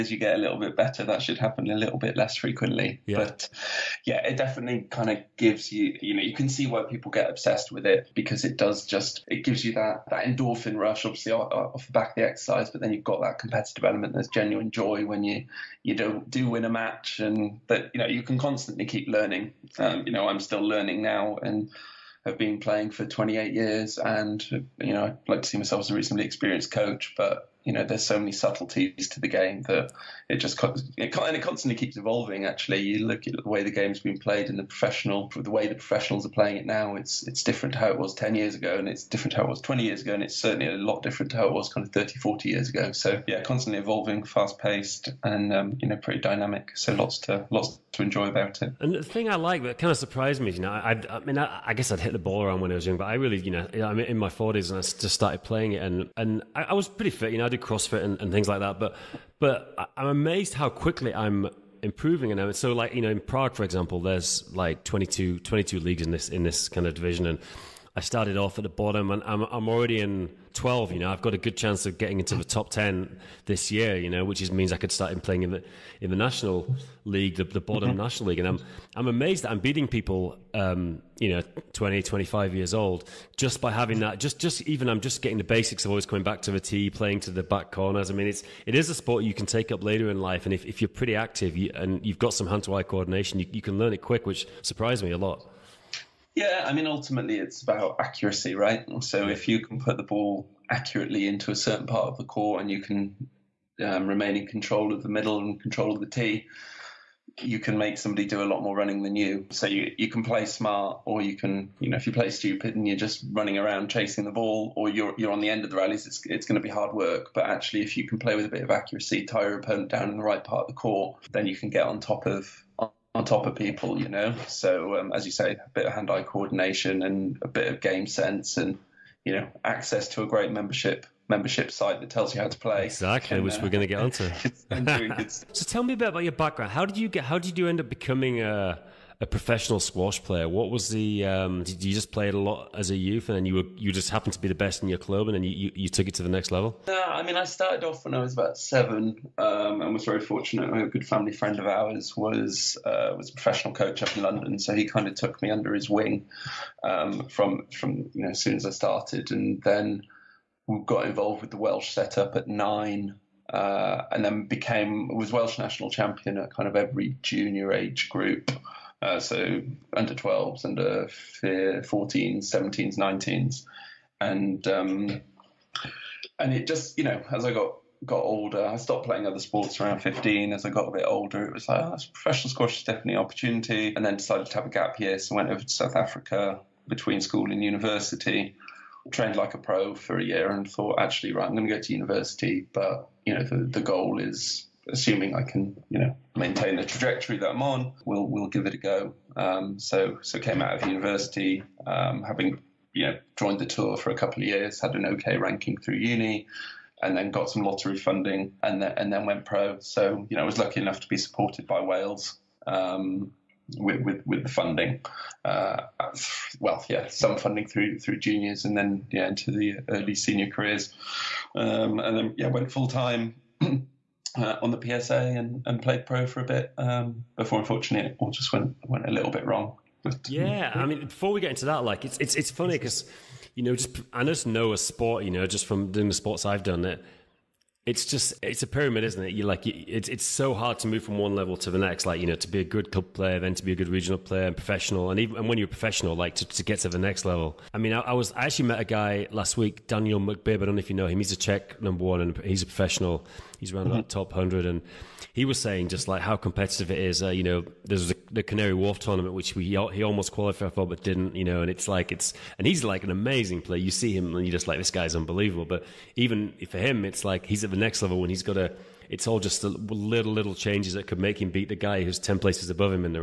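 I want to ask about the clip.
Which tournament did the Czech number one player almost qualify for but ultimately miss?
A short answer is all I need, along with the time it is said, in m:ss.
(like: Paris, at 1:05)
Canary Wharf, at 4:18.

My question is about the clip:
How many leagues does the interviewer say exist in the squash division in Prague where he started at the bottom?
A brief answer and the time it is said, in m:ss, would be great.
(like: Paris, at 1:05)
22, at 1:05.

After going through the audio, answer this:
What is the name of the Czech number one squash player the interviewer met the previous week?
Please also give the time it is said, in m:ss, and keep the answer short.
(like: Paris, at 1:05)
Daniel Mekbib, at 4:09.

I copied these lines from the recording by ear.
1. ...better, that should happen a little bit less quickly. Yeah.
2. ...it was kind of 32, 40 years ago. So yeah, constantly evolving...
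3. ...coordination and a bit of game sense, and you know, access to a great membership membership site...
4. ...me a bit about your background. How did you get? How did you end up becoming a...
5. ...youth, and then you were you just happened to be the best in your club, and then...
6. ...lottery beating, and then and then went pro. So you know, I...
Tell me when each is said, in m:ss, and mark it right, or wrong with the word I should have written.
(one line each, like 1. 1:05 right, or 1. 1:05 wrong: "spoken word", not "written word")
1. 0:00 wrong: "frequently", not "quickly"
2. 0:41 wrong: "30", not "32"
3. 2:06 right
4. 2:15 right
5. 2:22 right
6. 3:27 wrong: "funding", not "beating".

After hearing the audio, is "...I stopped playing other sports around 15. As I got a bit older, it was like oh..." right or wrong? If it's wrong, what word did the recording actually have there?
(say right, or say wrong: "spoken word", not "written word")
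right.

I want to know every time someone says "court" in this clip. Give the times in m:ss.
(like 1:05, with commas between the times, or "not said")
1:42, 2:00.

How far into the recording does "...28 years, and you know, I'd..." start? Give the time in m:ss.
0:23.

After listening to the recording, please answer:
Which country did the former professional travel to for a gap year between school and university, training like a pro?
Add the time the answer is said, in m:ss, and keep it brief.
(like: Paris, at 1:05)
South Africa, at 3:05.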